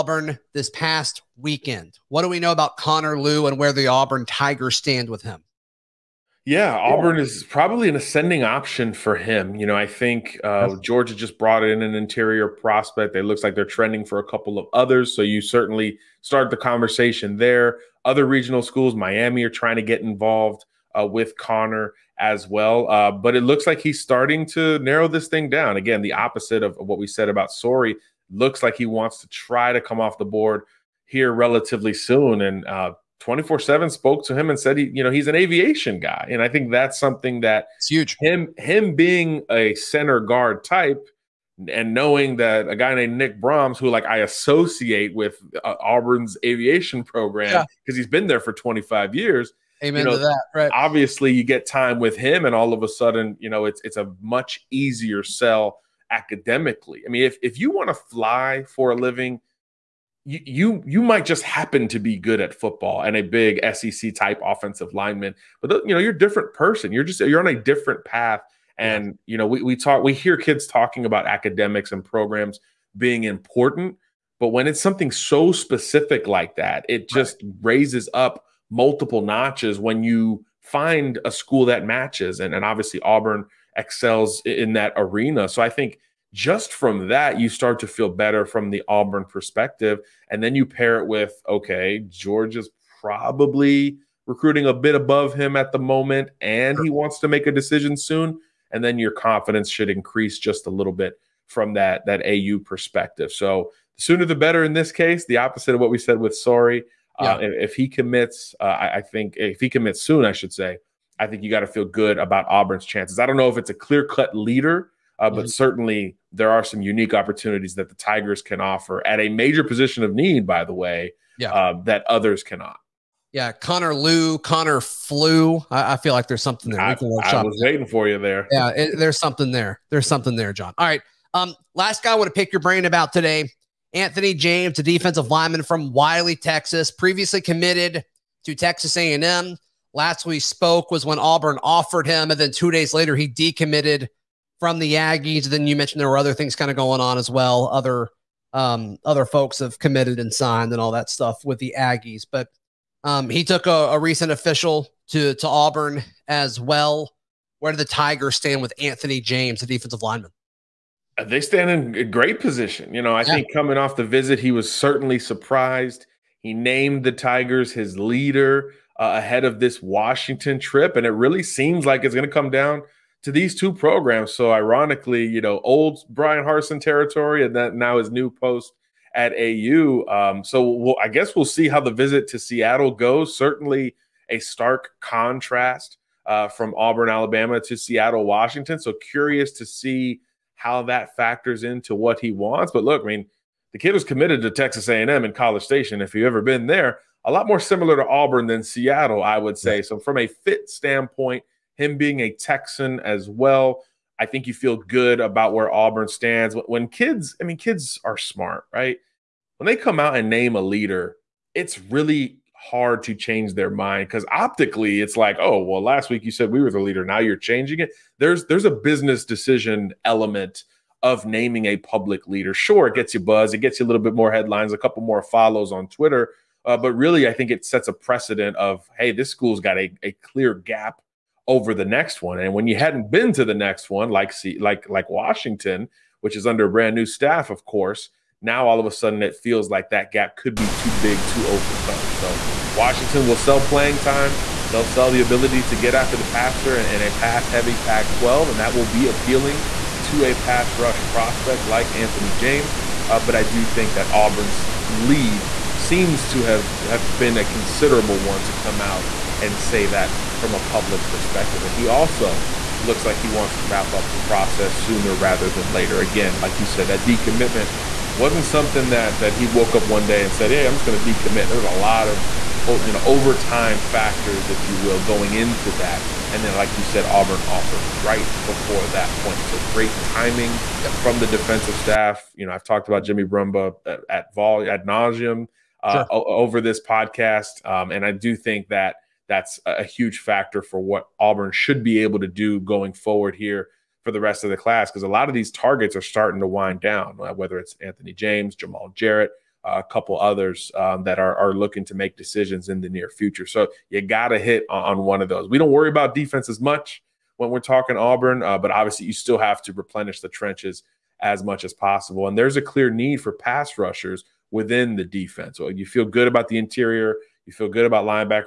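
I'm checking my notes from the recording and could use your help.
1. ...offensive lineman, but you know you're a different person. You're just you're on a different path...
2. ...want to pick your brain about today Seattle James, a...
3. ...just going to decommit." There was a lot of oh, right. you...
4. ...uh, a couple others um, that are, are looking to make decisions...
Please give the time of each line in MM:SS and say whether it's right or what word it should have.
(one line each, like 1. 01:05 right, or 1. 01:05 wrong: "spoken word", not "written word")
1. 01:04 right
2. 02:12 wrong: "Anthony", not "Seattle"
3. 04:30 right
4. 04:59 right.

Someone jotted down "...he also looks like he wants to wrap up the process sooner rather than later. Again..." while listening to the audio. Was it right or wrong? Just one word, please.
right.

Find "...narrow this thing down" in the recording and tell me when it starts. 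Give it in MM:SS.
00:24.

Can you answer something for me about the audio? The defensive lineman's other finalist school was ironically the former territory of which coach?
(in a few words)
Bryan Harsin.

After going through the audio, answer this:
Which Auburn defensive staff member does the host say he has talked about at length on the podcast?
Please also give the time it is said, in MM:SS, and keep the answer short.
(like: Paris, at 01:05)
Jimmy Brumbaugh, at 04:43.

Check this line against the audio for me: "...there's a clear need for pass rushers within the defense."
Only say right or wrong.
right.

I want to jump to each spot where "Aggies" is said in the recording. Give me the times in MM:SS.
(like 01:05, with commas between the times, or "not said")
02:24, 02:31.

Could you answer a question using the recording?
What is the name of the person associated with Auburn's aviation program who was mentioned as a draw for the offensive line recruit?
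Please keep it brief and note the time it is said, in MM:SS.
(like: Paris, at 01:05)
Nick Broms, at 00:43.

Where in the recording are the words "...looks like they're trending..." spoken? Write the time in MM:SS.
00:13.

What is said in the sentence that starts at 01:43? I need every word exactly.
So the sooner the better in this case, the opposite of what we said with Sorey.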